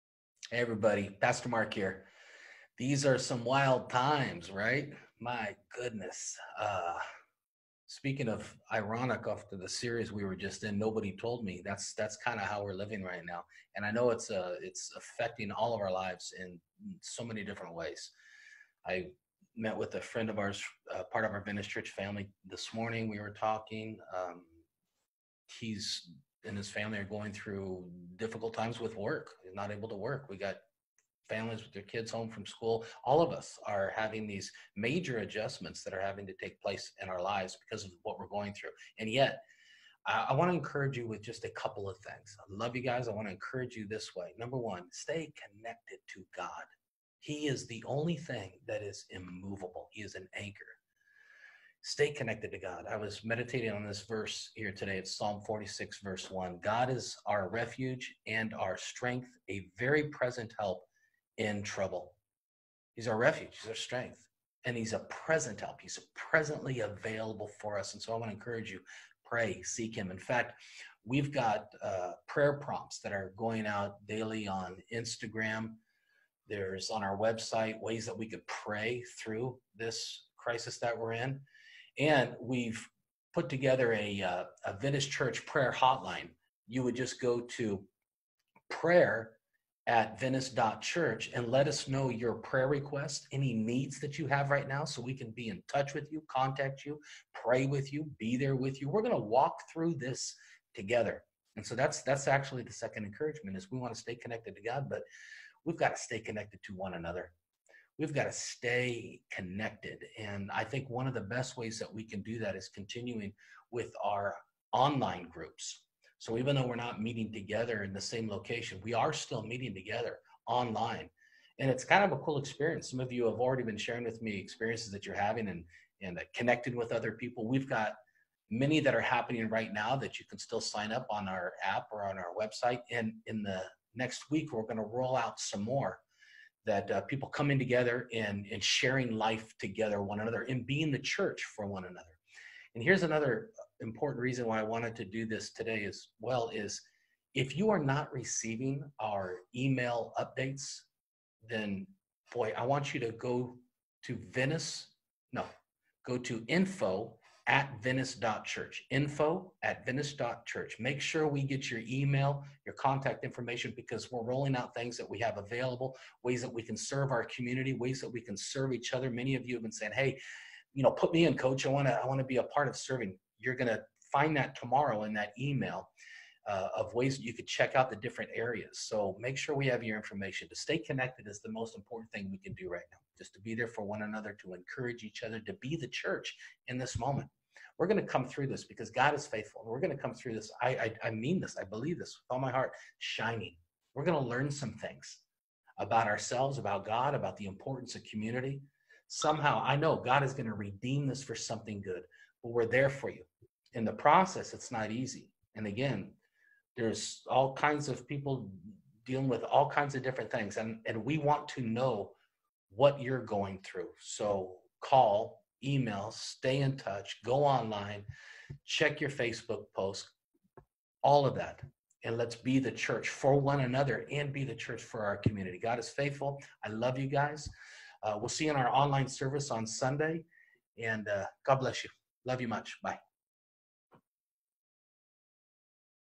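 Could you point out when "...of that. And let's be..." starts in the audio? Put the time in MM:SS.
03:41.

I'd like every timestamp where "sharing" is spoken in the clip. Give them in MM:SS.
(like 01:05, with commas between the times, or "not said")
02:03, 02:18.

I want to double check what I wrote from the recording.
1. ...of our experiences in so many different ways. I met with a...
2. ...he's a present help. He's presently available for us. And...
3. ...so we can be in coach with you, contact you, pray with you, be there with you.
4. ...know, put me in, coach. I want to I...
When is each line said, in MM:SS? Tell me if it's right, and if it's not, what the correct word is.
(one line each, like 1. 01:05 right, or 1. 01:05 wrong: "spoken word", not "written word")
1. 00:15 wrong: "lives", not "experiences"
2. 01:04 right
3. 01:34 wrong: "touch", not "coach"
4. 02:50 right.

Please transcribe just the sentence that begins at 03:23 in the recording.
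In the process, it's not easy.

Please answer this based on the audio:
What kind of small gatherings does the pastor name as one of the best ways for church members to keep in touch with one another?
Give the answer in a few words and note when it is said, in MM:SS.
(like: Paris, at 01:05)
online groups, at 01:54.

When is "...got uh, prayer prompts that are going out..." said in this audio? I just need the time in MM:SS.
01:11.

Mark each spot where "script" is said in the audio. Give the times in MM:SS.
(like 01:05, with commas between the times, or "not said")
not said.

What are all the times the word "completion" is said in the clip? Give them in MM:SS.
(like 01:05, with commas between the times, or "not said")
not said.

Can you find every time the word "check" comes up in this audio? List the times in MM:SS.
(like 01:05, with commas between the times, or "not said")
02:57, 03:38.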